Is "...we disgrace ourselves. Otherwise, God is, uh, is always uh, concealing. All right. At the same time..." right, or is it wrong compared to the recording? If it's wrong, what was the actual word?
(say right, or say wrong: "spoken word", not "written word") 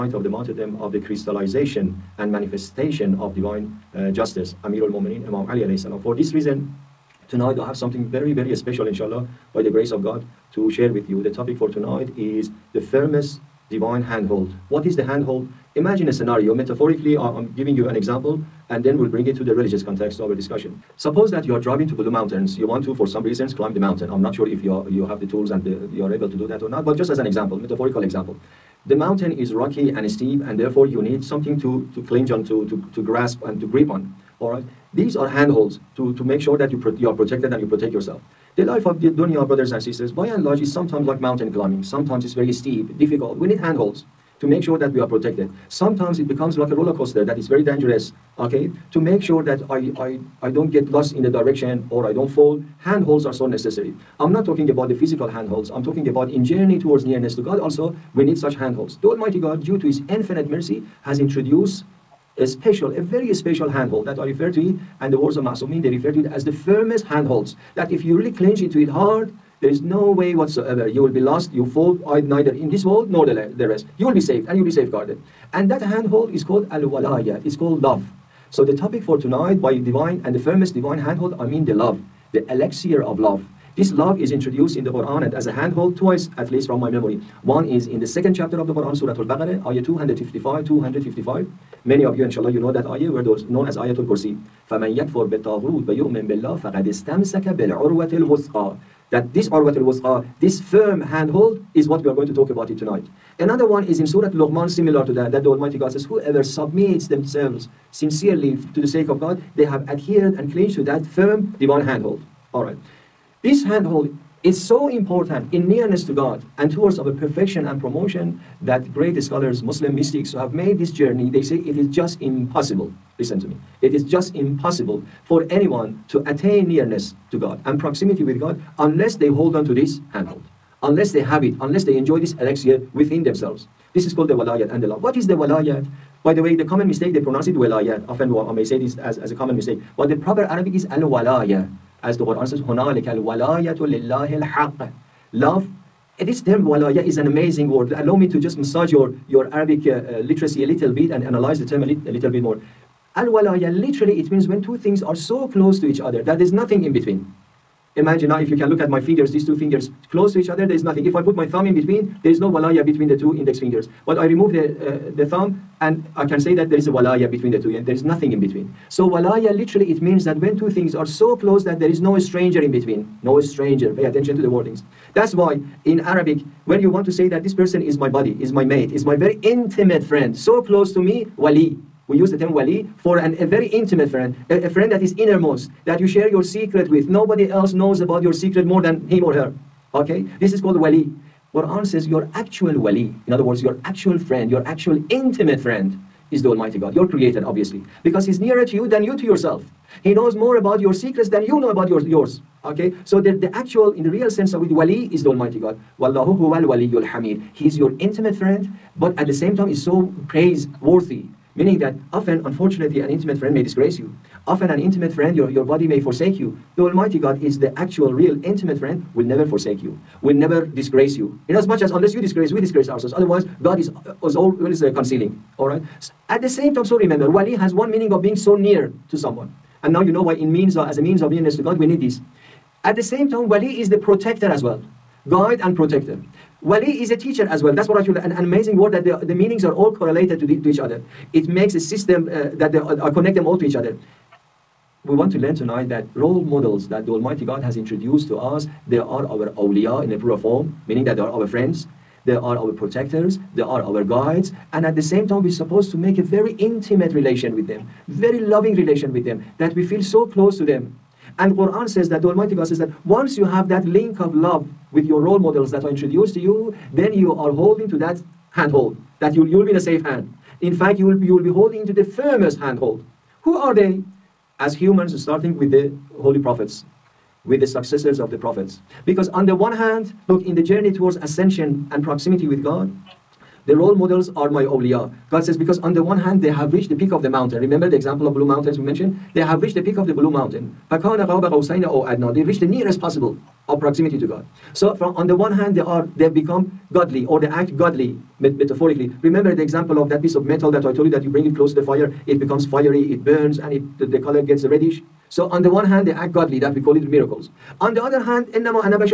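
right.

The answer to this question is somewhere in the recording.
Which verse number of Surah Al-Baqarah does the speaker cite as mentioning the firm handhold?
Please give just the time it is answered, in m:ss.
1:29.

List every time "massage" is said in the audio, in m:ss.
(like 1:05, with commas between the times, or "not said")
2:28.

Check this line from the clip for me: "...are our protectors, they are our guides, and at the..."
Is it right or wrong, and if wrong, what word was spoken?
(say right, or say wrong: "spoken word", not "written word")
right.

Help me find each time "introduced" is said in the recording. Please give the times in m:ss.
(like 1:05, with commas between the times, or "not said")
1:01, 1:24, 4:07, 4:25.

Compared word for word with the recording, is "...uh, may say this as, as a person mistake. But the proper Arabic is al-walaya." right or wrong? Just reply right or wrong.
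wrong.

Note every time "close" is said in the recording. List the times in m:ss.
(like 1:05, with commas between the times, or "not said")
2:35, 2:40, 2:51, 3:00, 4:20, 5:01.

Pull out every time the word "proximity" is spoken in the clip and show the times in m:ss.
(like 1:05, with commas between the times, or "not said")
2:07, 4:42, 4:53.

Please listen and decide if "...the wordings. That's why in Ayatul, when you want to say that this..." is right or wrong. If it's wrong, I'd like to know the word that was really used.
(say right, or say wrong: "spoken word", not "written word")
wrong: "Arabic", not "Ayatul".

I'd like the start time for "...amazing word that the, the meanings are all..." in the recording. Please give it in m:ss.
3:58.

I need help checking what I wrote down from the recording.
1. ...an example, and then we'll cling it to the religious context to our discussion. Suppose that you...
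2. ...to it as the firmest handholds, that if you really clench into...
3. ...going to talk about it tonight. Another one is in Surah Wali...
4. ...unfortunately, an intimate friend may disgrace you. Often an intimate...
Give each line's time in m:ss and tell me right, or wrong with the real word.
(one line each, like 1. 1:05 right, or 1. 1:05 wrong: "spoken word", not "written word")
1. 0:17 wrong: "bring", not "cling"
2. 1:06 right
3. 1:42 wrong: "Luqman", not "Wali"
4. 3:32 right.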